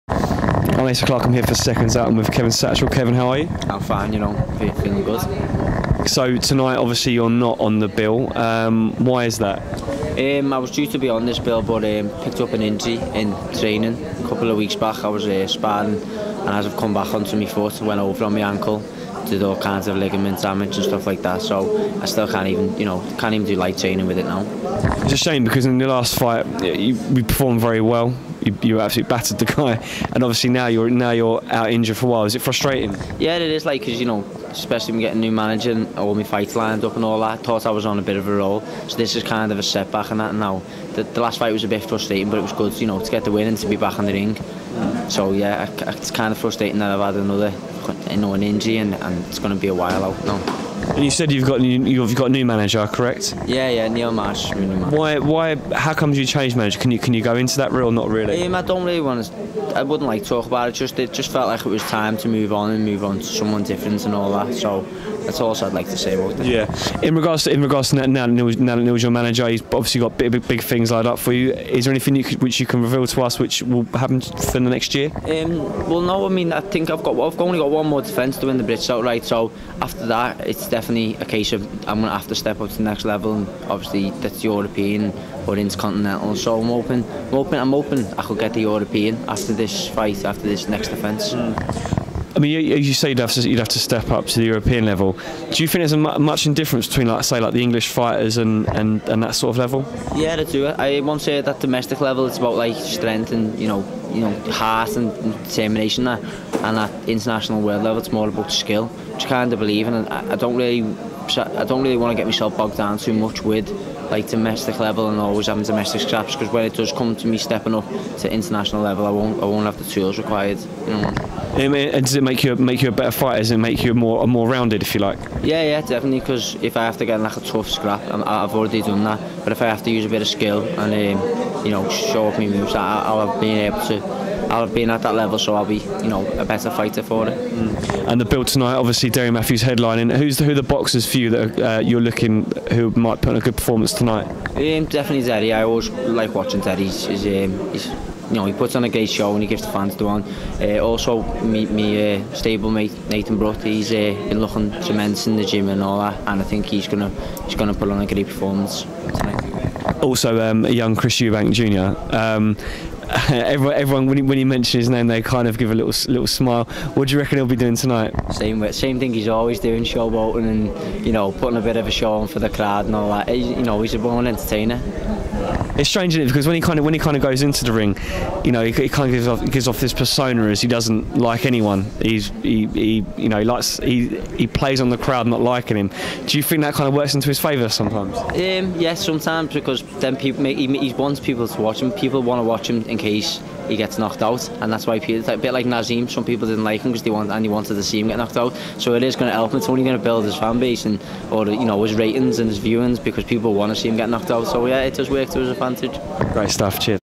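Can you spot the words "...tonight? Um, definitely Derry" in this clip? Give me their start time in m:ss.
2:23.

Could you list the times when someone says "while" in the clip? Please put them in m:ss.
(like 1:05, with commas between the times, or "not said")
0:32, 0:49.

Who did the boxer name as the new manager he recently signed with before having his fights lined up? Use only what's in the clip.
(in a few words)
Neil Marsh.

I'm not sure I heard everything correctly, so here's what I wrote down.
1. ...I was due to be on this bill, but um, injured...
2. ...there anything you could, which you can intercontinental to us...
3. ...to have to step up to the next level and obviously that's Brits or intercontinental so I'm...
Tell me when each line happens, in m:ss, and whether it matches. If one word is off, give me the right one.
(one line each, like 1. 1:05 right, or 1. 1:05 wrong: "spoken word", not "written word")
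1. 0:10 wrong: "picked", not "injured"
2. 1:11 wrong: "reveal", not "intercontinental"
3. 1:22 wrong: "European", not "Brits".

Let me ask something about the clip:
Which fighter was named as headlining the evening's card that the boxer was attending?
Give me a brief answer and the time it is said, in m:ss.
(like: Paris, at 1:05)
Derry Matthews, at 2:19.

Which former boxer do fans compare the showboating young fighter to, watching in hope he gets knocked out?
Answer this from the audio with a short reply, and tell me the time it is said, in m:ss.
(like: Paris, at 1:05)
Naseem, at 3:15.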